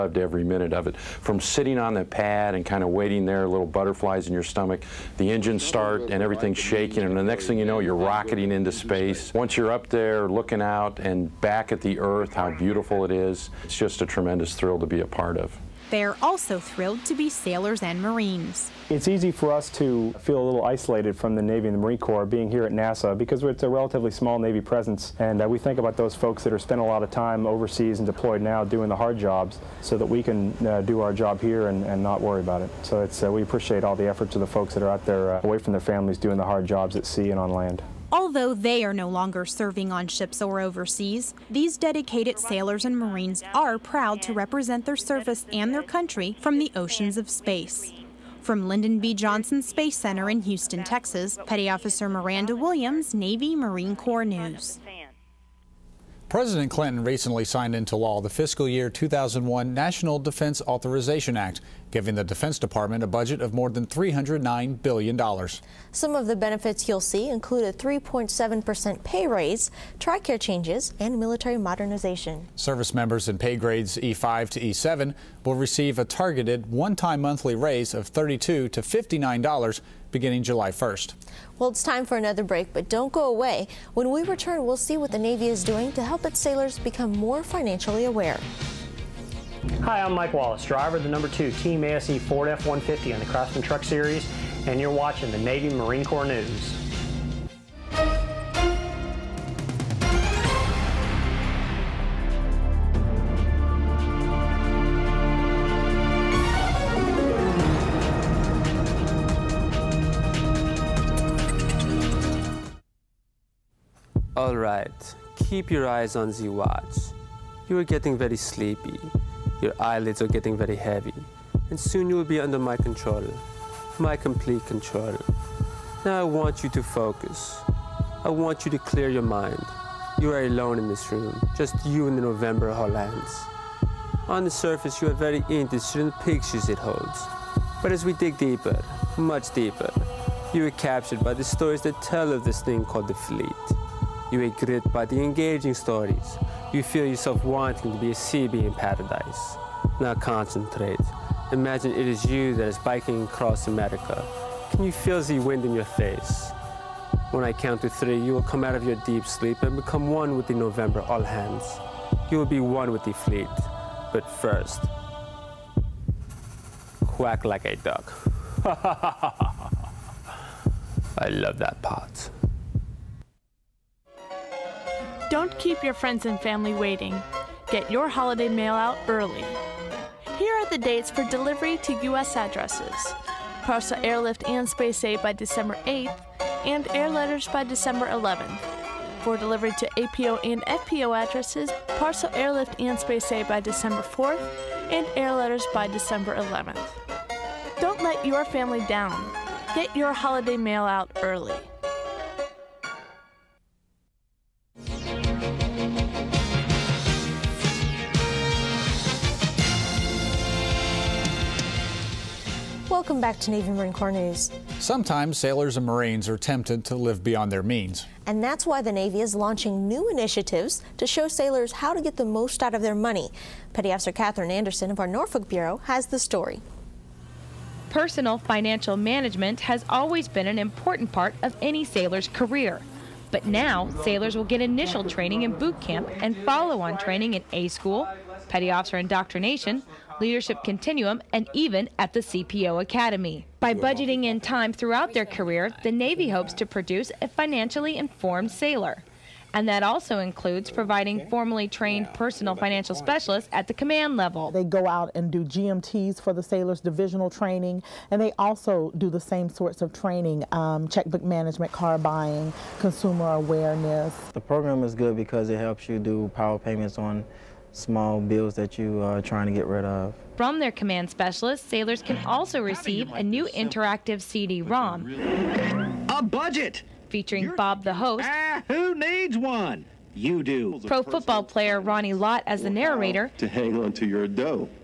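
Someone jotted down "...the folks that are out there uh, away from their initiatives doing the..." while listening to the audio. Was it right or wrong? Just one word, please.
wrong.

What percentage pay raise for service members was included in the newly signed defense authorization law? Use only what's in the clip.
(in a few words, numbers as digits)
3.7%.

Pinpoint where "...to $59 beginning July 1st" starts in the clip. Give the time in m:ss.
1:18.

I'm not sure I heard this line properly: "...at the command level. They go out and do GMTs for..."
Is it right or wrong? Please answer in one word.
right.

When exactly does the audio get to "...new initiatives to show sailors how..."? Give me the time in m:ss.
3:39.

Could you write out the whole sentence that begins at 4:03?
By budgeting in time throughout their career, the Navy hopes to produce a financially informed sailor.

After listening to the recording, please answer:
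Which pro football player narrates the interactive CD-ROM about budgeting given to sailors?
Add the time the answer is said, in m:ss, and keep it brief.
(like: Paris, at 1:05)
Ronnie Lott, at 4:41.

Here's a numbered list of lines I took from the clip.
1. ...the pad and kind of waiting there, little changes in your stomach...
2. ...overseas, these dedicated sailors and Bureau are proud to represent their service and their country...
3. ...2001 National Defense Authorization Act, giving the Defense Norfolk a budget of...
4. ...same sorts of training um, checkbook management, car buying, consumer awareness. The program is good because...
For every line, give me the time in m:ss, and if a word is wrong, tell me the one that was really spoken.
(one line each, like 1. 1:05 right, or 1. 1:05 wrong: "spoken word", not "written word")
1. 0:01 wrong: "butterflies", not "changes"
2. 0:40 wrong: "Marines", not "Bureau"
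3. 0:58 wrong: "Department", not "Norfolk"
4. 4:19 right.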